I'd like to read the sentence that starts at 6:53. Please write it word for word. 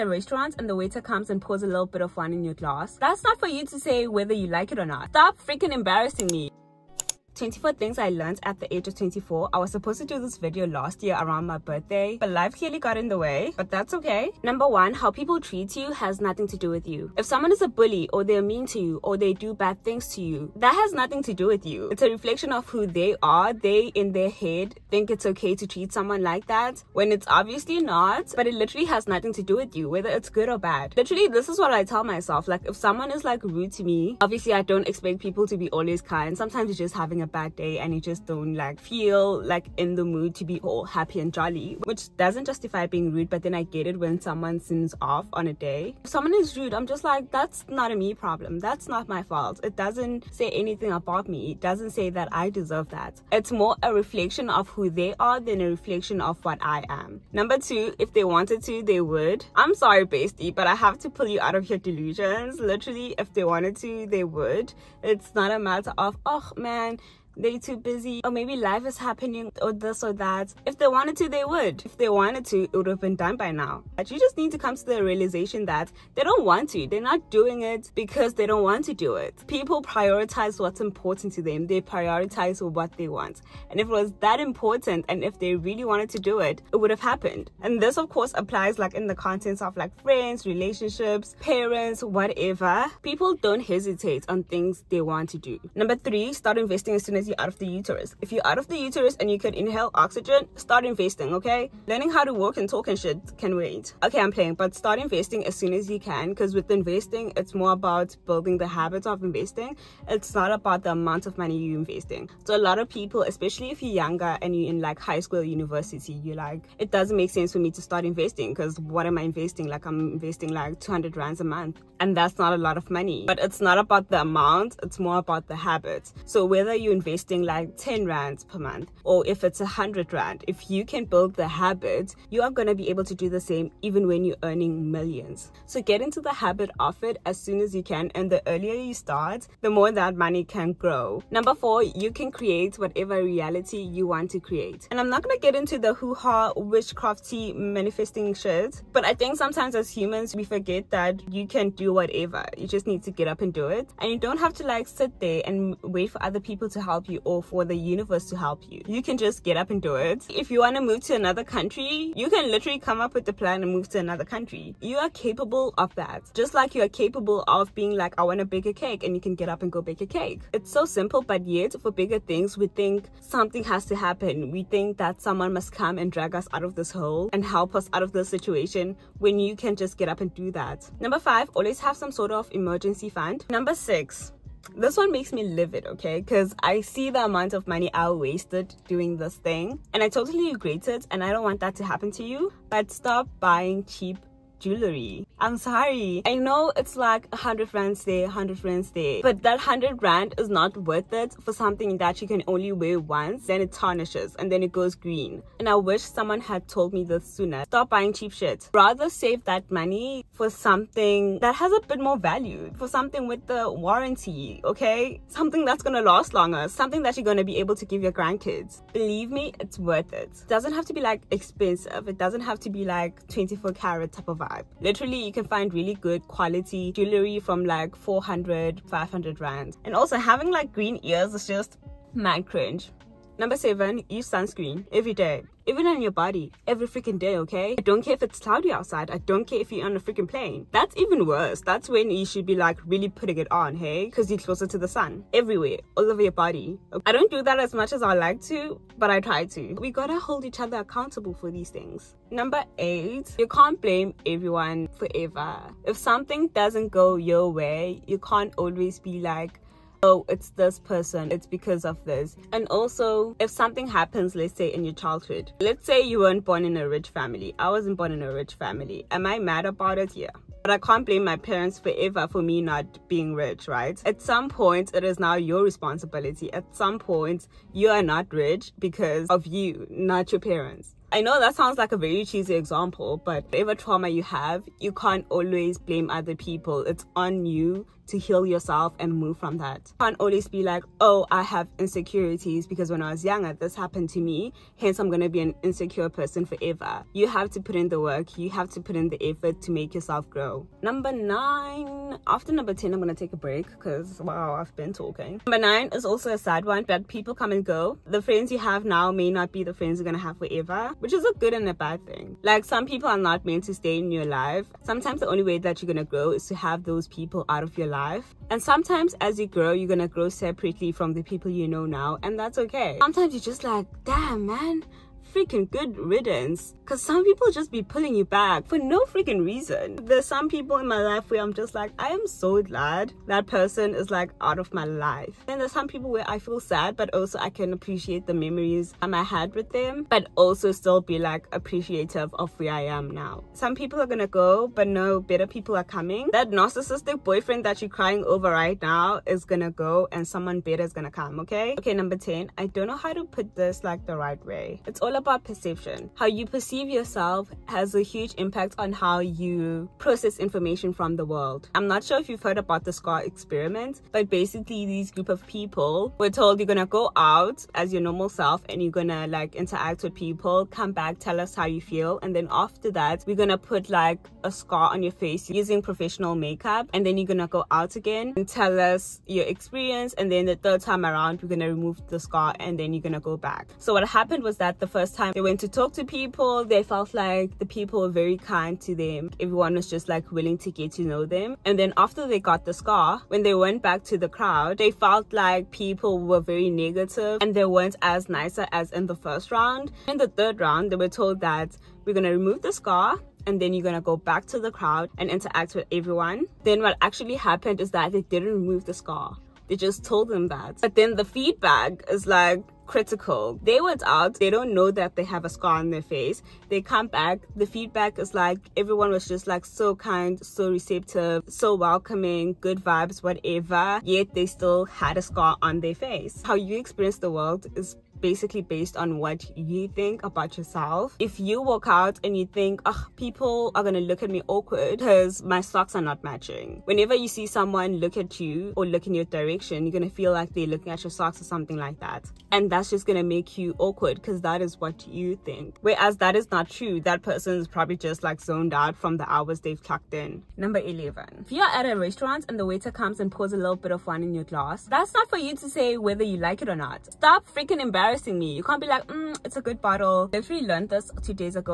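They went out, they don't know that they have a scar on their face.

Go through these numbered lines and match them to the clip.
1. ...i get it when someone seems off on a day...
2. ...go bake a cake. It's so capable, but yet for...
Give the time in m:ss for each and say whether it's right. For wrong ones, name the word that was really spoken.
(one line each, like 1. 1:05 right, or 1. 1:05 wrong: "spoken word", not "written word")
1. 0:43 right
2. 2:49 wrong: "simple", not "capable".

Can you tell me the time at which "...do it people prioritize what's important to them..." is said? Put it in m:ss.
1:18.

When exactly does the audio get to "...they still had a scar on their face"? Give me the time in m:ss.
7:04.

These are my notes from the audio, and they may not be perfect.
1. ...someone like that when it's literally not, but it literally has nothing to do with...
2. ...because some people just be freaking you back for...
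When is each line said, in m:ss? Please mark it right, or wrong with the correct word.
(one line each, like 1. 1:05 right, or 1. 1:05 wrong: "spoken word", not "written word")
1. 0:25 wrong: "obviously", not "literally"
2. 5:26 wrong: "pulling", not "freaking".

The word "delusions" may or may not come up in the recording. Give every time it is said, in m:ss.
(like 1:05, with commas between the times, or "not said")
1:01.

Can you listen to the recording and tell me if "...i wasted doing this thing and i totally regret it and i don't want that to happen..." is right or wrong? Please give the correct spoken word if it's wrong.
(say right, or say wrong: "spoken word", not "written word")
right.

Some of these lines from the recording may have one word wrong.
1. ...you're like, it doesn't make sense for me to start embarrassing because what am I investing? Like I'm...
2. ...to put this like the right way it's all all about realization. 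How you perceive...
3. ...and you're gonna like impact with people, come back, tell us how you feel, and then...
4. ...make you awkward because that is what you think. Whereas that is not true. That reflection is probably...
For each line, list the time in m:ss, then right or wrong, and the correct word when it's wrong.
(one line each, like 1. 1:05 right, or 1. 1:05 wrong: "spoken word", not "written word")
1. 1:56 wrong: "investing", not "embarrassing"
2. 5:53 wrong: "perception", not "realization"
3. 6:08 wrong: "interact", not "impact"
4. 7:23 wrong: "person", not "reflection".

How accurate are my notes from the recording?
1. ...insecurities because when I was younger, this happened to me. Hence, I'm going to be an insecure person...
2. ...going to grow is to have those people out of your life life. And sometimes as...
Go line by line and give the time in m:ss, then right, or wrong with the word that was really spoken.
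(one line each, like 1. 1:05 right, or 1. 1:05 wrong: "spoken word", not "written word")
1. 4:51 right
2. 5:15 right.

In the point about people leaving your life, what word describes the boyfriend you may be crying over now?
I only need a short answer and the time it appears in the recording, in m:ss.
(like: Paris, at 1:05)
narcissistic, at 5:46.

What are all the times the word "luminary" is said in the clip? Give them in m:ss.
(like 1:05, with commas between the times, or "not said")
not said.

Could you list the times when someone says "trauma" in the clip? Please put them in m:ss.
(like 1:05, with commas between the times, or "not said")
4:43.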